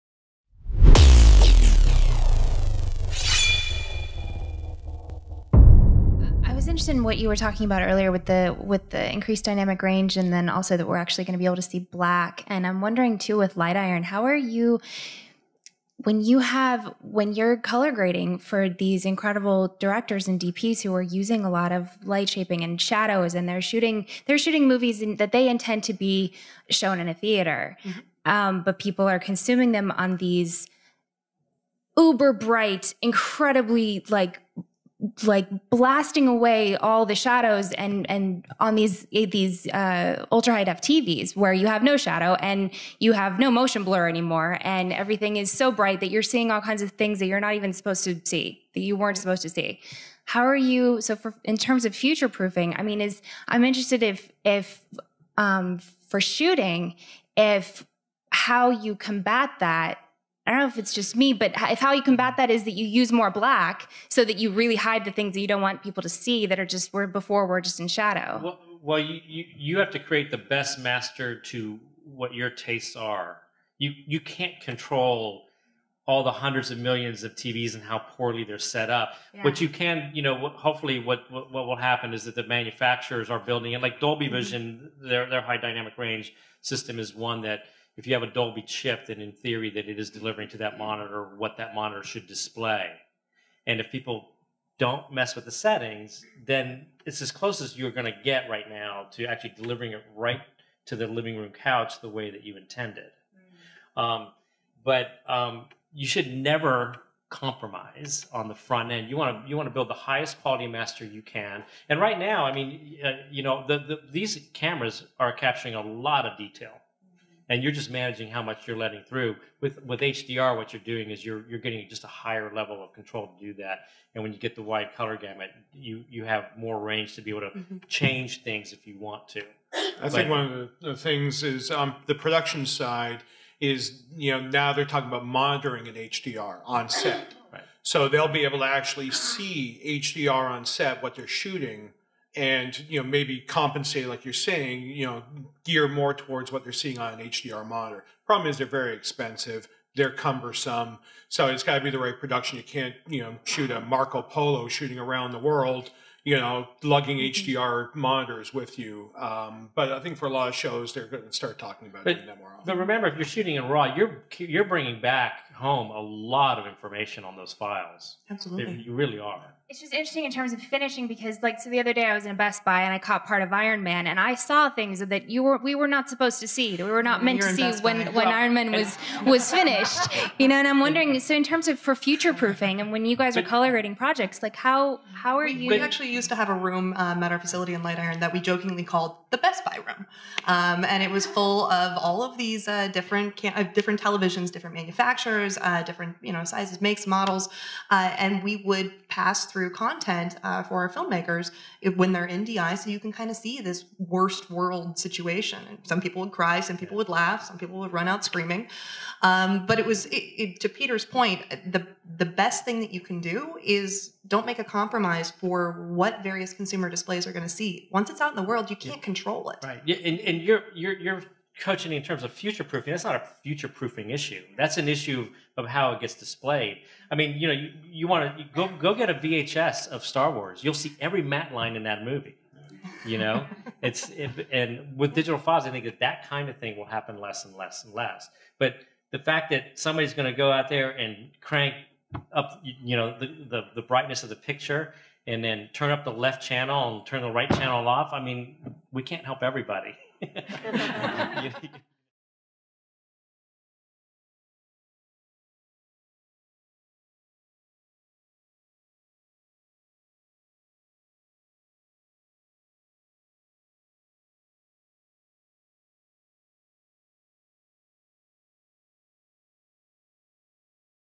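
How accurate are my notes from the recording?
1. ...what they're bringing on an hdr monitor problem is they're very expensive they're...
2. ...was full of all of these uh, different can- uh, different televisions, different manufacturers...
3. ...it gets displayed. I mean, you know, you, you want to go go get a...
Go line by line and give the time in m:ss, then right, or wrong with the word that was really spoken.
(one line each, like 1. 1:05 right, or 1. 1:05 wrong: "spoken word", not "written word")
1. 2:26 wrong: "seeing", not "bringing"
2. 3:11 right
3. 3:45 right.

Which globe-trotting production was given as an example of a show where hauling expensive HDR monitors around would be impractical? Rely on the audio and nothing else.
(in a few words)
Marco Polo.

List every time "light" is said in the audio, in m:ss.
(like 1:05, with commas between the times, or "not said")
0:13, 0:22, 3:07.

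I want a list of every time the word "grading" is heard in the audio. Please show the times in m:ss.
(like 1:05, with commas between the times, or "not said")
0:17, 3:03.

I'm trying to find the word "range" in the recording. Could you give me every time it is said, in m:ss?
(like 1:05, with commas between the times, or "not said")
0:09, 1:25, 2:06.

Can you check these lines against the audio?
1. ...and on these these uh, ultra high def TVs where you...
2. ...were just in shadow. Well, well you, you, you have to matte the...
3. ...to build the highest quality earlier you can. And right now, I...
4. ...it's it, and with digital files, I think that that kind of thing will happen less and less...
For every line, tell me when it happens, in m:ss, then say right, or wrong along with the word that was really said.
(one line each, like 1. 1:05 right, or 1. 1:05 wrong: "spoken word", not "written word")
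1. 0:38 right
2. 1:07 wrong: "create", not "matte"
3. 1:49 wrong: "master", not "earlier"
4. 3:53 right.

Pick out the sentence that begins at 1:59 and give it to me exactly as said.
With with HDR, what you're doing is you're you're getting just a higher level of control to do that.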